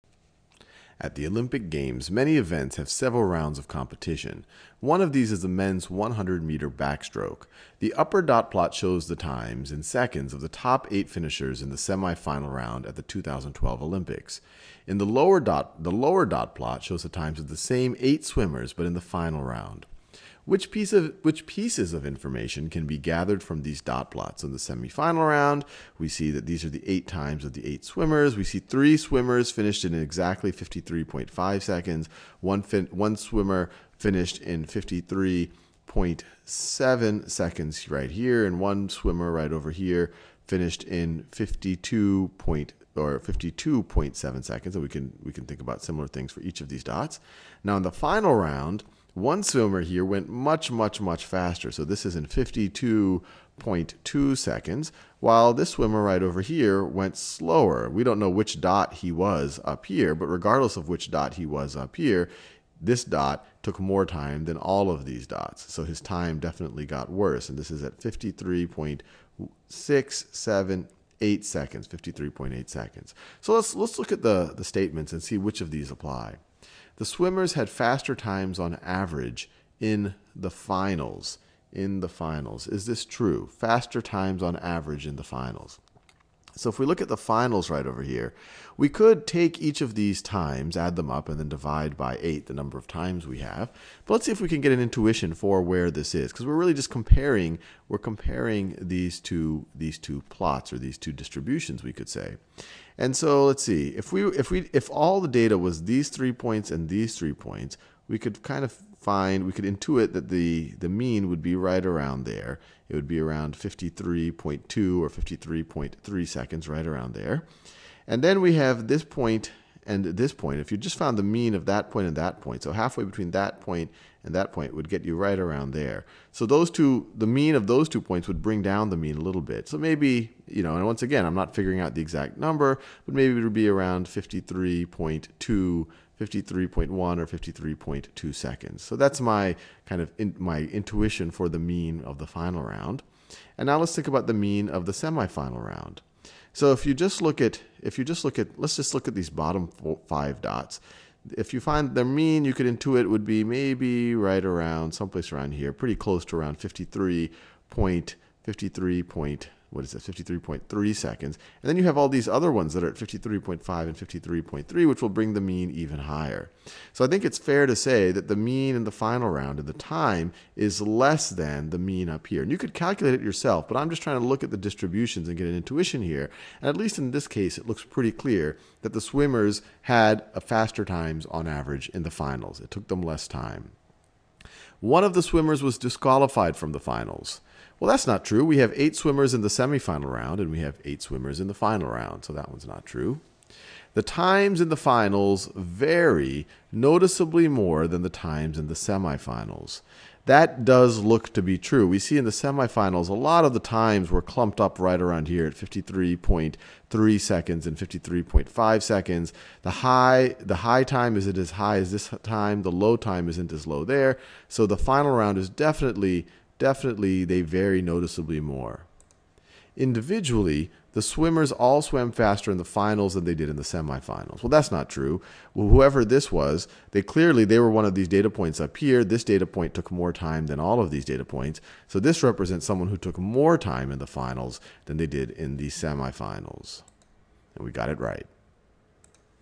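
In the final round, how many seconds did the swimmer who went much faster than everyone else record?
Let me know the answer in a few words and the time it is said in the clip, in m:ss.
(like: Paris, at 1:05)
52.2 seconds, at 0:52.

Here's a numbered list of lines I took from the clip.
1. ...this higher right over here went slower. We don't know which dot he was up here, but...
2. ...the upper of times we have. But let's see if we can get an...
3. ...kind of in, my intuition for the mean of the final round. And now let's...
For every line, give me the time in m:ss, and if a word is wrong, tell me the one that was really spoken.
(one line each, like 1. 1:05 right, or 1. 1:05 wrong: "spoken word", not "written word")
1. 0:55 wrong: "swimmer", not "higher"
2. 1:32 wrong: "number", not "upper"
3. 2:19 right.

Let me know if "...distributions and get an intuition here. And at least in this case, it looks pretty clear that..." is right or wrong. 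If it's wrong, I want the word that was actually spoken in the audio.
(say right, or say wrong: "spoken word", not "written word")
right.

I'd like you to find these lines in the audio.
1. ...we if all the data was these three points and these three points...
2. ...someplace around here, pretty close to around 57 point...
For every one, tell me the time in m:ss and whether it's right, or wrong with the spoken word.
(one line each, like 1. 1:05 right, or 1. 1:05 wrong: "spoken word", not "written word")
1. 1:44 right
2. 2:34 wrong: "53", not "57".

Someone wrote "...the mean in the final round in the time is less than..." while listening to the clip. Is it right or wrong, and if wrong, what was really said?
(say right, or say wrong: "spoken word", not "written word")
right.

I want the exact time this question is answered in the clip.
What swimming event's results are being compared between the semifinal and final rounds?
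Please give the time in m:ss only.
0:05.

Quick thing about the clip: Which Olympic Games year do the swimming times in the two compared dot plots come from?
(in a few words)
2012.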